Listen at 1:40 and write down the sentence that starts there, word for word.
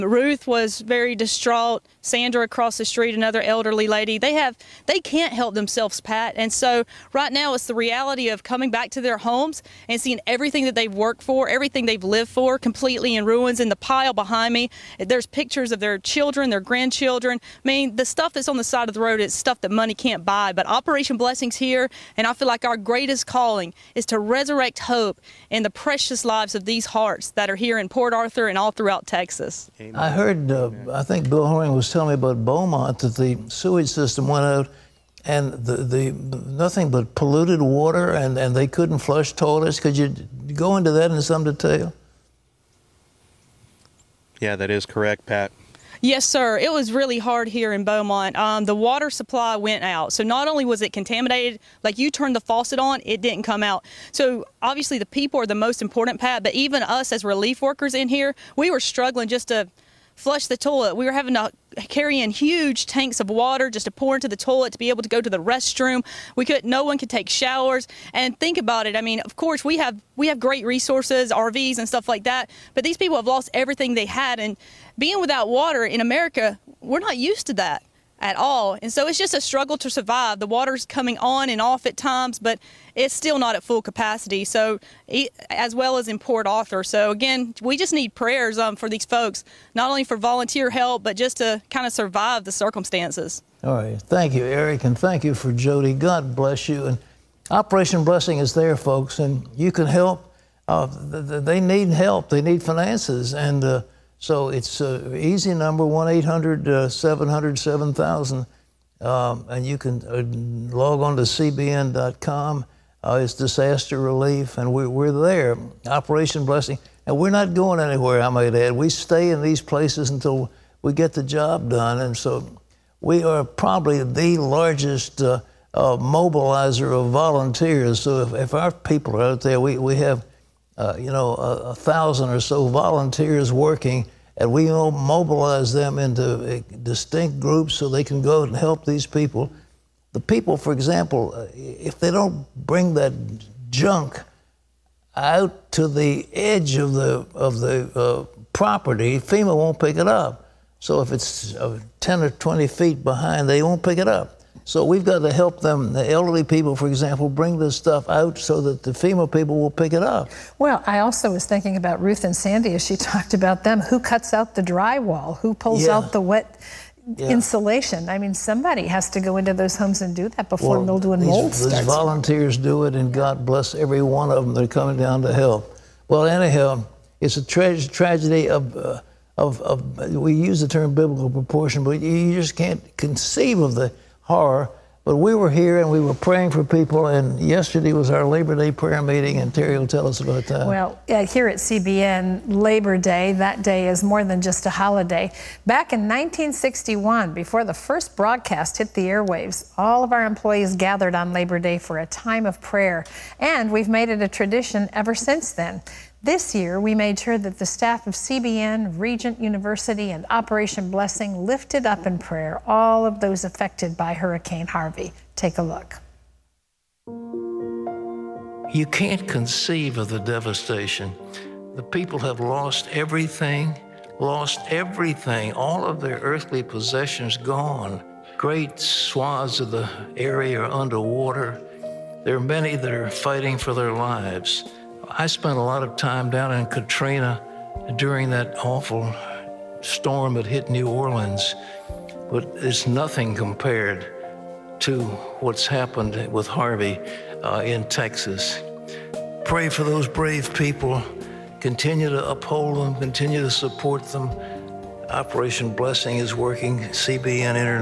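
Uh, they need help, they need finances.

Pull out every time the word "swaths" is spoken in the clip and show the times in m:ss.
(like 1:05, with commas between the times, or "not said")
3:48.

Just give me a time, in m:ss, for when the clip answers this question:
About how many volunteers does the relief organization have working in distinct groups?
2:11.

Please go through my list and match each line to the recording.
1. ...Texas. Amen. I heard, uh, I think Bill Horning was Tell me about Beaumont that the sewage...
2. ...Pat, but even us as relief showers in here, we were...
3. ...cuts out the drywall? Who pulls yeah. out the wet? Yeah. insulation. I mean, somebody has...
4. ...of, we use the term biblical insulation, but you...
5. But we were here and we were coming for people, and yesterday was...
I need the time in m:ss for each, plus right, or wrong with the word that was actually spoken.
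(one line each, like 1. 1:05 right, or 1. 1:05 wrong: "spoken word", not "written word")
1. 0:29 right
2. 0:56 wrong: "workers", not "showers"
3. 2:43 right
4. 2:59 wrong: "proportion", not "insulation"
5. 3:05 wrong: "praying", not "coming".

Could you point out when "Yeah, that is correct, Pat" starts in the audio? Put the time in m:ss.
0:44.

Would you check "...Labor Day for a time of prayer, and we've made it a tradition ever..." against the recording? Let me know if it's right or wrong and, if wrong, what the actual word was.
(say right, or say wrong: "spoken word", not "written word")
right.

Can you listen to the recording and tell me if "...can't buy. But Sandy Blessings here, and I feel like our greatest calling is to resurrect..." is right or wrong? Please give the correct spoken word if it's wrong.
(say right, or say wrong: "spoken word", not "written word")
wrong: "Operation", not "Sandy".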